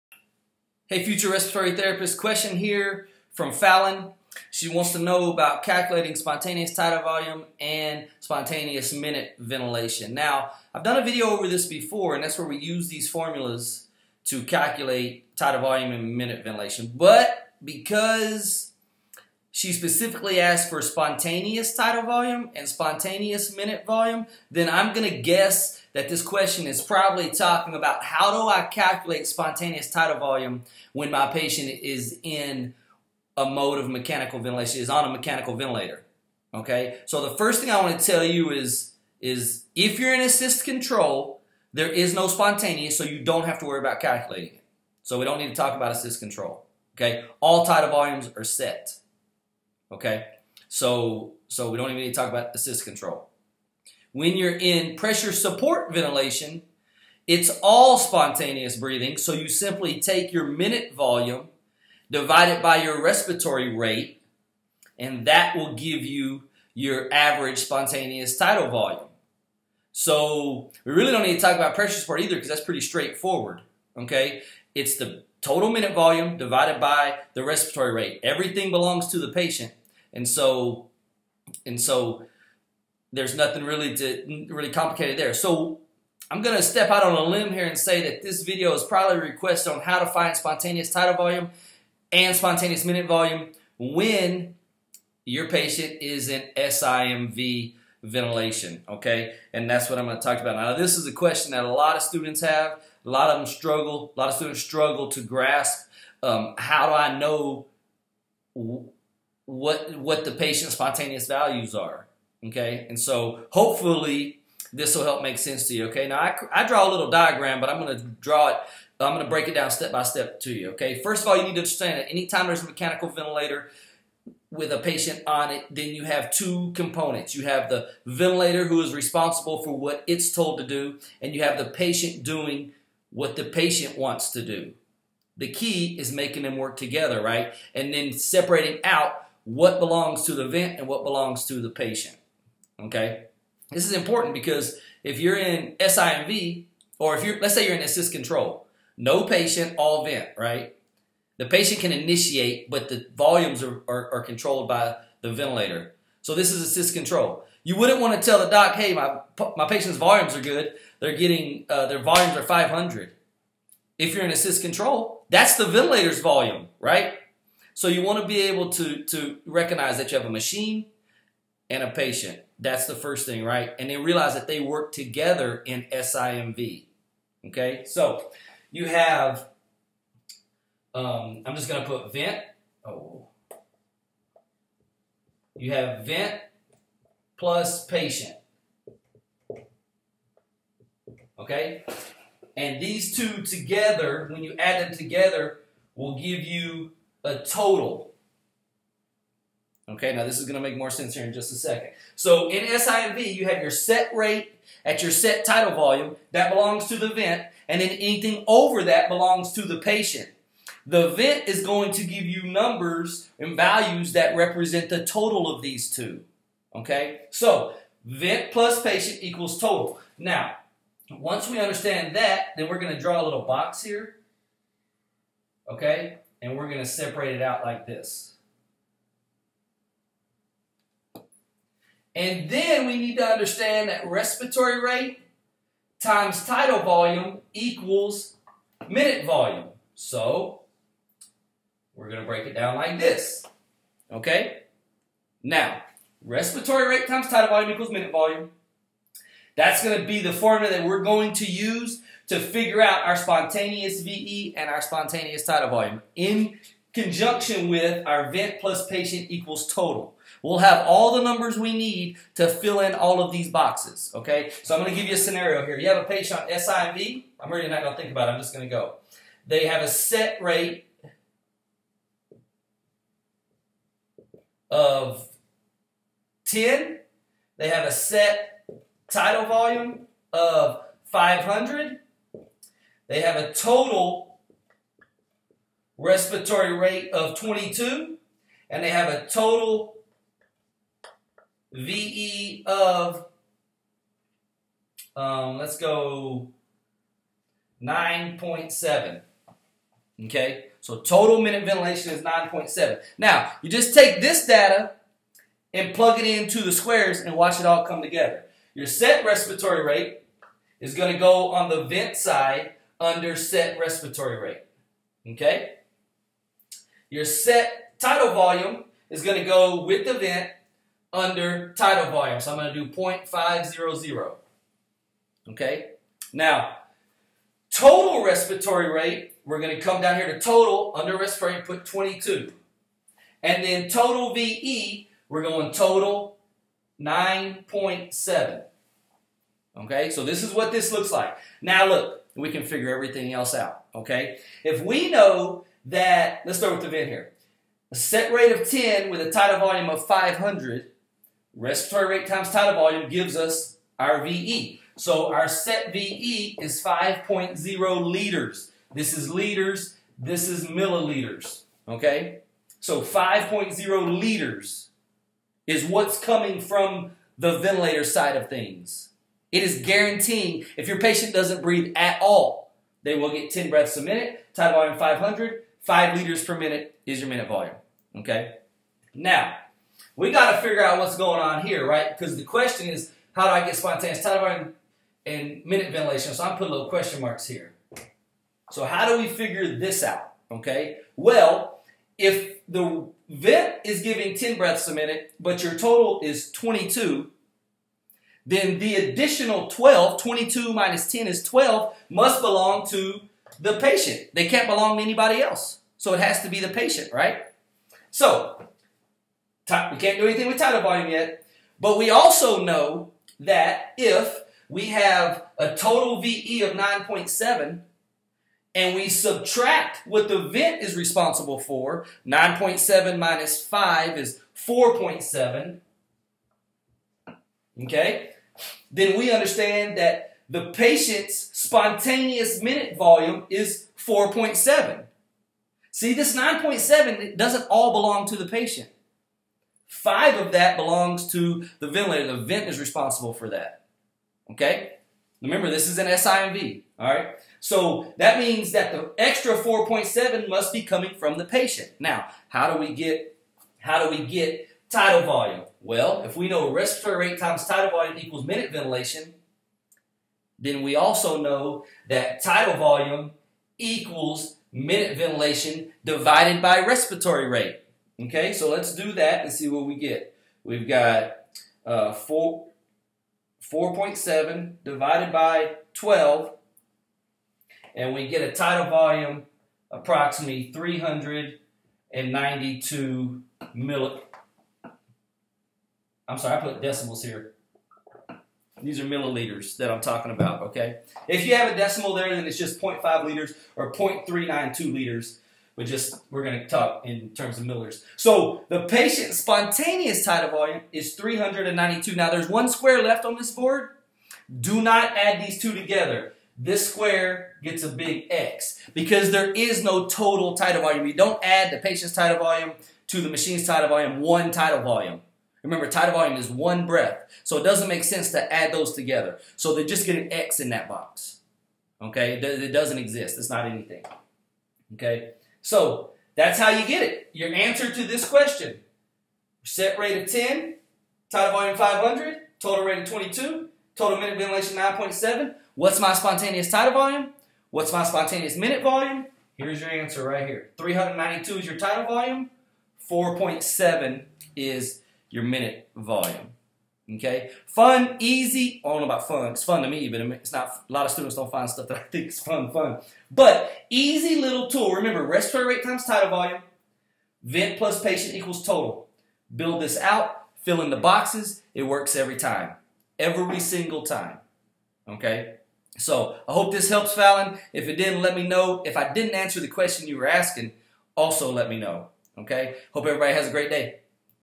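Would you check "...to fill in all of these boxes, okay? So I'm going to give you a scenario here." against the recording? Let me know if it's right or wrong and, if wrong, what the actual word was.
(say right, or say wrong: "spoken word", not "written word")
right.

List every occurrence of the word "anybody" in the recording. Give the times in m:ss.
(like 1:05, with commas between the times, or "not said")
6:45.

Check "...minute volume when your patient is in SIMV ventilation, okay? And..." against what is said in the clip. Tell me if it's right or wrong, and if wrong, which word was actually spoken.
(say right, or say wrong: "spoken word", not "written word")
right.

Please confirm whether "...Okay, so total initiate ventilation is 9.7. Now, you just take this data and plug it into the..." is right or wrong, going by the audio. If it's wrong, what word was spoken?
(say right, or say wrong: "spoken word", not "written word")
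wrong: "minute", not "initiate".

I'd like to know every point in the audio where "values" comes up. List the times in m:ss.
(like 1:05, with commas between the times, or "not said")
1:51, 3:33.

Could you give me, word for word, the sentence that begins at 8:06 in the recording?
I'm sorry, I put decimals here.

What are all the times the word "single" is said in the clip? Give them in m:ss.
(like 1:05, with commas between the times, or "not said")
9:23.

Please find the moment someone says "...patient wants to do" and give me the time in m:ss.
2:13.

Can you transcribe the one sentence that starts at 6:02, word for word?
So 5.0 liters is what's coming from the ventilator side of things.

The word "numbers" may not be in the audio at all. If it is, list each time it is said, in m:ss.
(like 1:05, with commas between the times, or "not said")
3:32, 4:21.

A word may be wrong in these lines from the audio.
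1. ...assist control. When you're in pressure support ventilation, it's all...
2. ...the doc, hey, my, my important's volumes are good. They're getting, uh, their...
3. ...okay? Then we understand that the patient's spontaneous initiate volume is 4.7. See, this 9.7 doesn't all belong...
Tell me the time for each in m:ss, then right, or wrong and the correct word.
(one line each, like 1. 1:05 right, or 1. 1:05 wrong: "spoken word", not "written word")
1. 0:52 right
2. 2:38 wrong: "patient", not "important"
3. 7:07 wrong: "minute", not "initiate".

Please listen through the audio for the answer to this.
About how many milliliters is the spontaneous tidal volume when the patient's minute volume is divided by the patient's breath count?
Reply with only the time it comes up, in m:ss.
7:59.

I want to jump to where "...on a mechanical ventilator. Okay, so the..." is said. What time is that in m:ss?
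0:34.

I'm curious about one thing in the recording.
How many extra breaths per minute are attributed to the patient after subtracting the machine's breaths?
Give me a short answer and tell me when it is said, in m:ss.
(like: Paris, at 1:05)
12, at 6:40.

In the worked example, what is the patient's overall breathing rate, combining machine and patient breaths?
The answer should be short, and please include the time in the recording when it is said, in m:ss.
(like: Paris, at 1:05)
22, at 4:43.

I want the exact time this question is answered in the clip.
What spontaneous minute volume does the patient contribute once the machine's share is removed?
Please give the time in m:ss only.
7:02.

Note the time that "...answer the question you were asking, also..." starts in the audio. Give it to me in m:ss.
9:29.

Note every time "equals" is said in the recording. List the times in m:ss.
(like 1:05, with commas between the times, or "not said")
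3:39, 3:57, 4:07, 4:19, 7:38, 7:43, 9:18.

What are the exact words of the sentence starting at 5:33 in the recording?
And then total VE, we're going total 9.7.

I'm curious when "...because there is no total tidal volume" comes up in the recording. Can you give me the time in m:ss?
8:28.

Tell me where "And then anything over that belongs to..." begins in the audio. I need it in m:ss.
3:27.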